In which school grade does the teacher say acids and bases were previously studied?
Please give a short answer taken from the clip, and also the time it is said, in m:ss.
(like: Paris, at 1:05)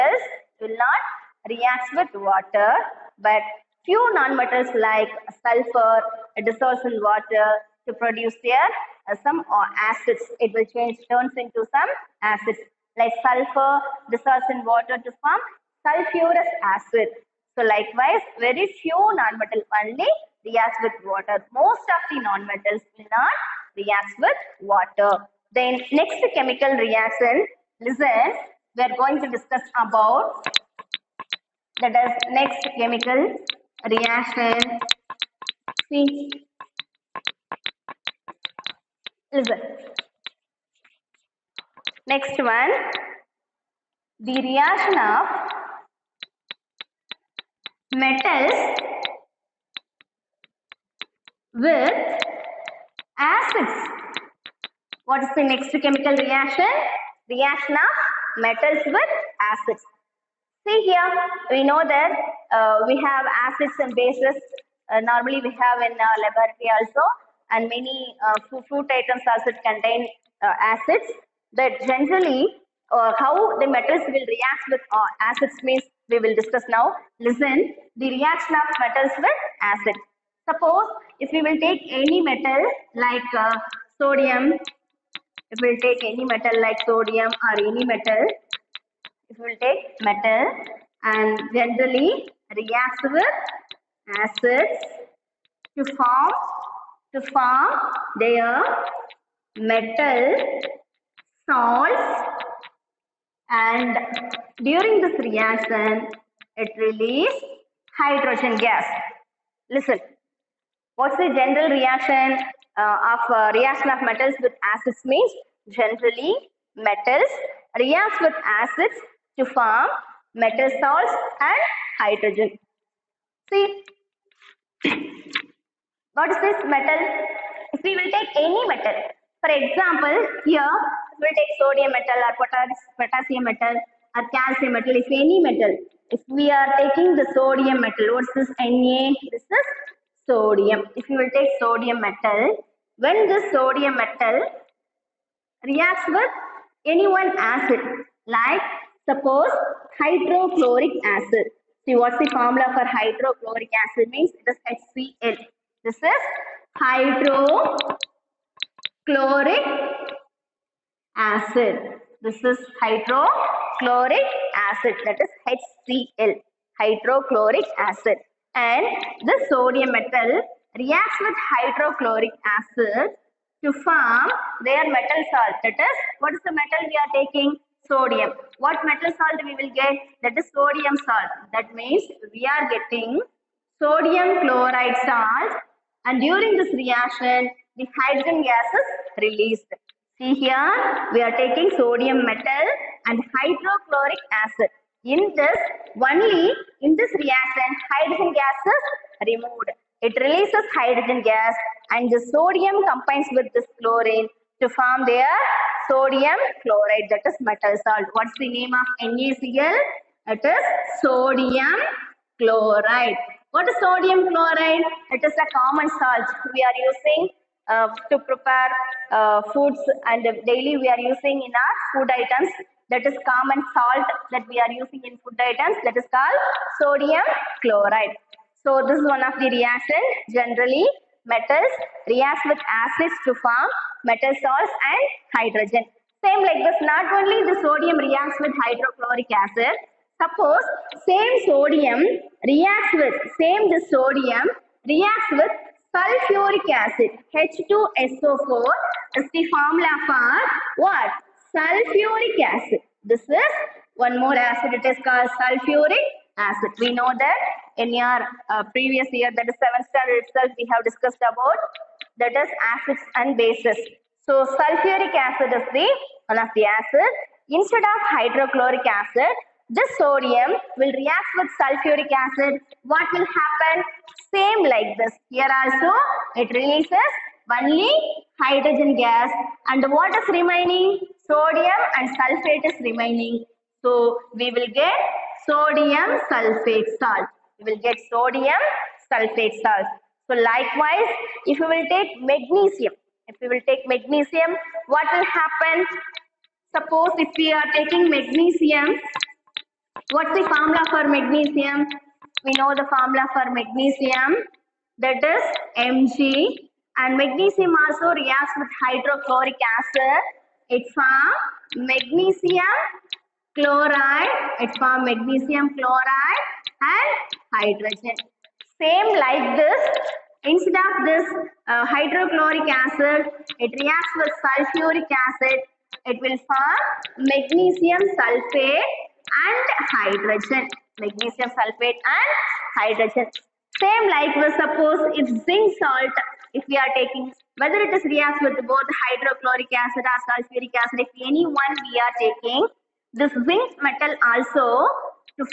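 7th standard, at 4:19.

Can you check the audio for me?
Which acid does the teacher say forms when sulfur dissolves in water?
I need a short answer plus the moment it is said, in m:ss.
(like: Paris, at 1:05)
sulfurous acid, at 0:15.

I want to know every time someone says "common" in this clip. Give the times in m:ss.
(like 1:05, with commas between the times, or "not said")
3:35, 3:43.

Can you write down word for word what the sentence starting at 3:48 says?
So this is one of the reaction generally metals react with acids to form metal salts and hydrogen.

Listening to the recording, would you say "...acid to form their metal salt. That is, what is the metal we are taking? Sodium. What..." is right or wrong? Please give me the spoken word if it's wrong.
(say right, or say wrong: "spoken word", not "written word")
right.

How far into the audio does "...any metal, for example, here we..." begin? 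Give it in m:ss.
2:08.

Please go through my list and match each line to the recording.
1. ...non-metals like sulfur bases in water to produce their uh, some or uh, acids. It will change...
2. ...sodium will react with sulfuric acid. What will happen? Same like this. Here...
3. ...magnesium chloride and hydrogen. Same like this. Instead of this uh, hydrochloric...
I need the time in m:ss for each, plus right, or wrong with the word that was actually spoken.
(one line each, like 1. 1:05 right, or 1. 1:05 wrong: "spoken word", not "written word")
1. 0:04 wrong: "dissolves", not "bases"
2. 4:29 right
3. 5:15 right.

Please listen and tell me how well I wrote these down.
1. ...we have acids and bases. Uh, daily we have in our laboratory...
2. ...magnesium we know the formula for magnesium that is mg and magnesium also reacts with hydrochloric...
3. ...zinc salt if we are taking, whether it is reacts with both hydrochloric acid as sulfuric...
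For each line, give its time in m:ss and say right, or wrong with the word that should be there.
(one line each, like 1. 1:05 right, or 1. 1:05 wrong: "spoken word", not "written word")
1. 1:02 wrong: "normally", not "daily"
2. 5:01 right
3. 5:35 right.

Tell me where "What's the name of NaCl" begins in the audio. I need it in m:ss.
3:28.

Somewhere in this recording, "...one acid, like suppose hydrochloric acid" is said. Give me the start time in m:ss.
2:27.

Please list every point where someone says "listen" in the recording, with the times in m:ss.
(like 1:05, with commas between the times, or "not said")
0:27, 0:39, 1:17, 1:49.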